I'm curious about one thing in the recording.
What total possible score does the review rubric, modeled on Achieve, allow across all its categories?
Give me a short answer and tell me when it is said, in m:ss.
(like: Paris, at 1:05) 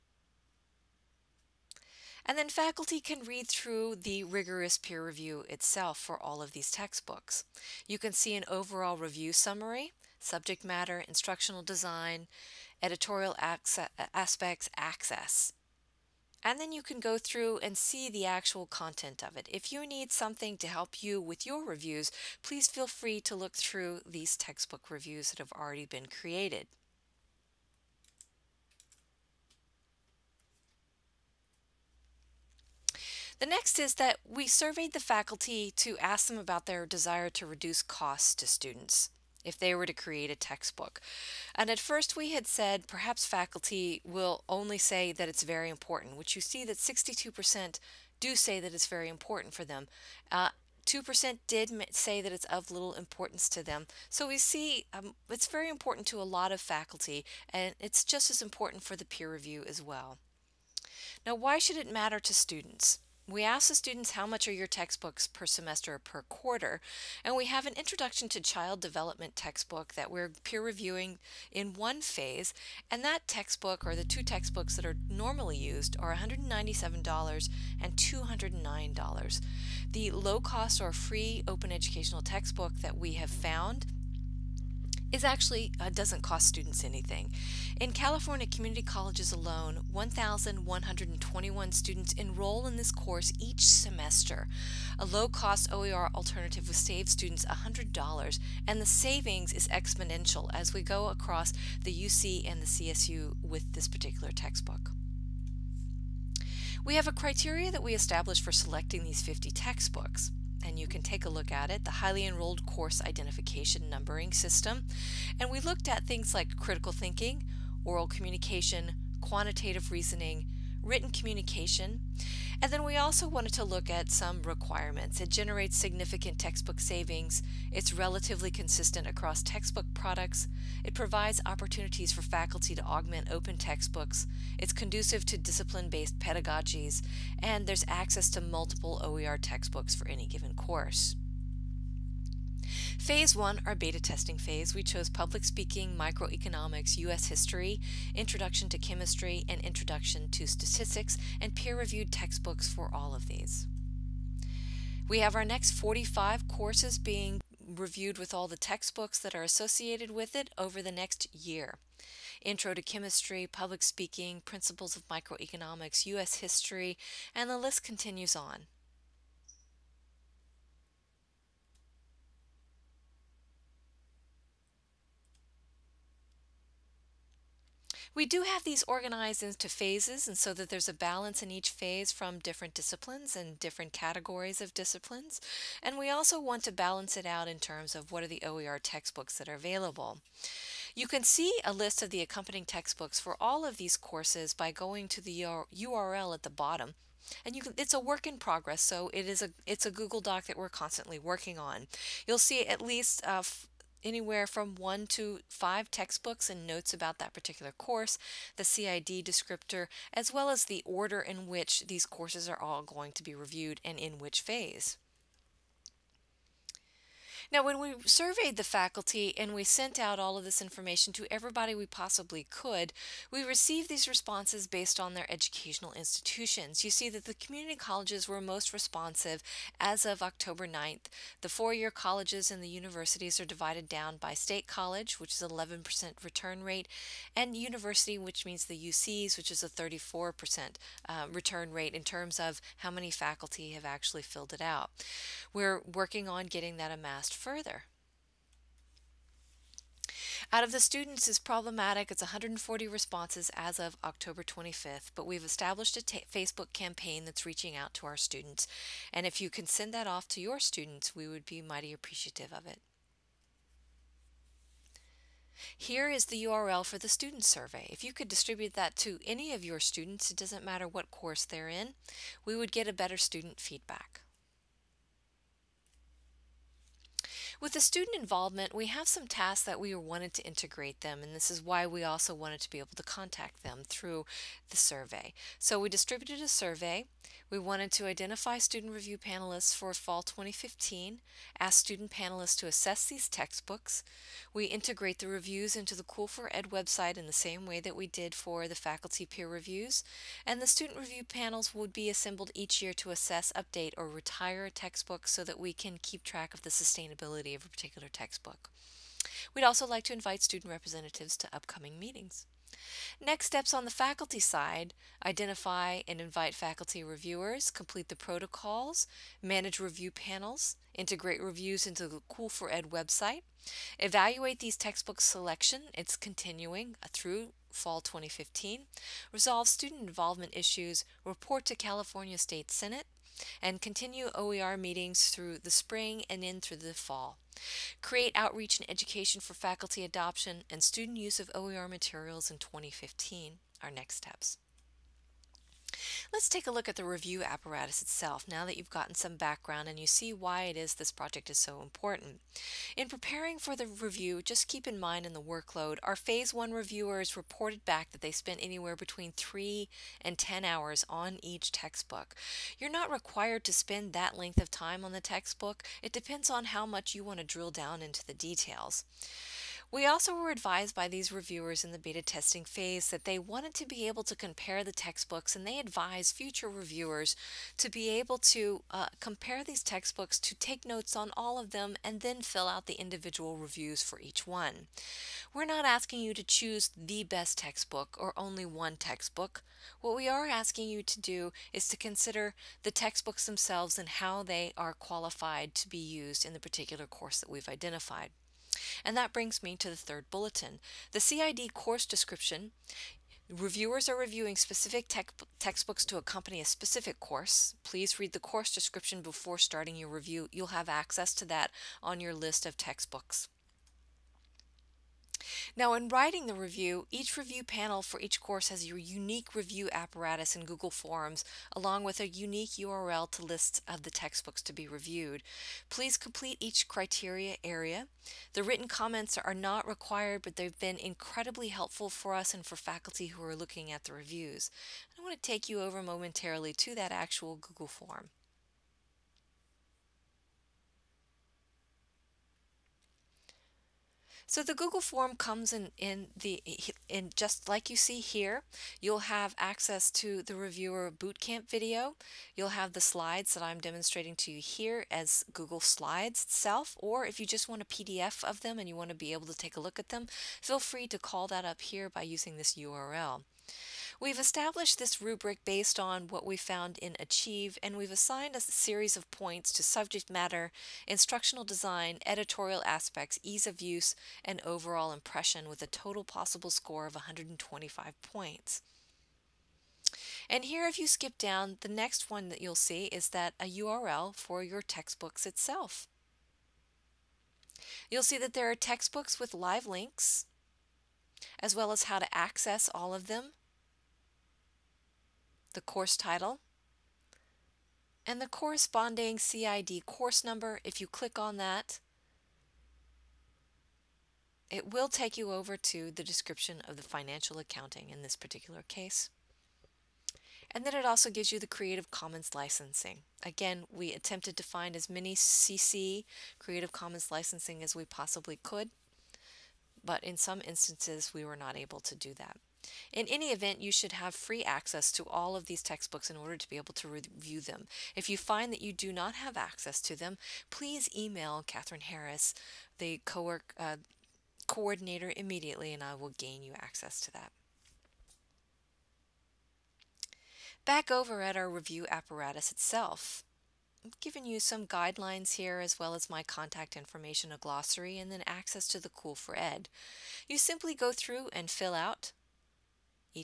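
125 points, at 7:57.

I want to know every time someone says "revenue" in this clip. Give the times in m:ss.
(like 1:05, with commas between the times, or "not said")
not said.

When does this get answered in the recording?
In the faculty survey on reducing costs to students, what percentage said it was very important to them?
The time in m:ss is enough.
0:46.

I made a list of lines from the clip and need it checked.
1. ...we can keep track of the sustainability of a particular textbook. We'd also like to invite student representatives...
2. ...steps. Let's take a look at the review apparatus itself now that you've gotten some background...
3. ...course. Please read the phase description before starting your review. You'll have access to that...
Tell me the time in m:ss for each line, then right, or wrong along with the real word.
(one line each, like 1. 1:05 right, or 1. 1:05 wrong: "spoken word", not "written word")
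1. 5:05 right
2. 5:44 right
3. 6:47 wrong: "course", not "phase".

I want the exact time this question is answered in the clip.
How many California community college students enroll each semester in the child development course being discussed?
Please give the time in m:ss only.
1:29.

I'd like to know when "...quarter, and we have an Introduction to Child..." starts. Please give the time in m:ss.
1:06.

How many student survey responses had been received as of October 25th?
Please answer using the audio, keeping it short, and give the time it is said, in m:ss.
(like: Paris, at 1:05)
140, at 4:12.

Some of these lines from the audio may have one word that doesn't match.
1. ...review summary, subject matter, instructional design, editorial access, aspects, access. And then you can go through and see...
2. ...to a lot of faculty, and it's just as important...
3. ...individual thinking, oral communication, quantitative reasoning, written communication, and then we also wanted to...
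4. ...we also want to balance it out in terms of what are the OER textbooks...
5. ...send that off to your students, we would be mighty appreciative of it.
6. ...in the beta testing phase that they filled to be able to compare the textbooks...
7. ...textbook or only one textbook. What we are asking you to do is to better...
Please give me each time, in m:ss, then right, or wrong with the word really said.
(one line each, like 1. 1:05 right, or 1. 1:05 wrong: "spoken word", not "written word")
1. 0:08 right
2. 0:56 right
3. 1:56 wrong: "critical", not "individual"
4. 3:05 right
5. 4:19 right
6. 6:11 wrong: "wanted", not "filled"
7. 6:27 wrong: "consider", not "better".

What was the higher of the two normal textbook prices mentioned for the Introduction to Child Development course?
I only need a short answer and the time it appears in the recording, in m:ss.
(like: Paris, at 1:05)
$209, at 1:17.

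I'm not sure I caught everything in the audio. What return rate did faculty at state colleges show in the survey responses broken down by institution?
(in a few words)
11%.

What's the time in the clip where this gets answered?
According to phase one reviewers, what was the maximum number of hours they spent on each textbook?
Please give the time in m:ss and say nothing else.
6:00.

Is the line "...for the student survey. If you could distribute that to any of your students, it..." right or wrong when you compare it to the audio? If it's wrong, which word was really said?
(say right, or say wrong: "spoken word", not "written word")
right.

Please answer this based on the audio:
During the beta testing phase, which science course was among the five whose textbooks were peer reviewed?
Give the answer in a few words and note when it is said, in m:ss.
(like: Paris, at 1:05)
Introduction to chemistry, at 2:28.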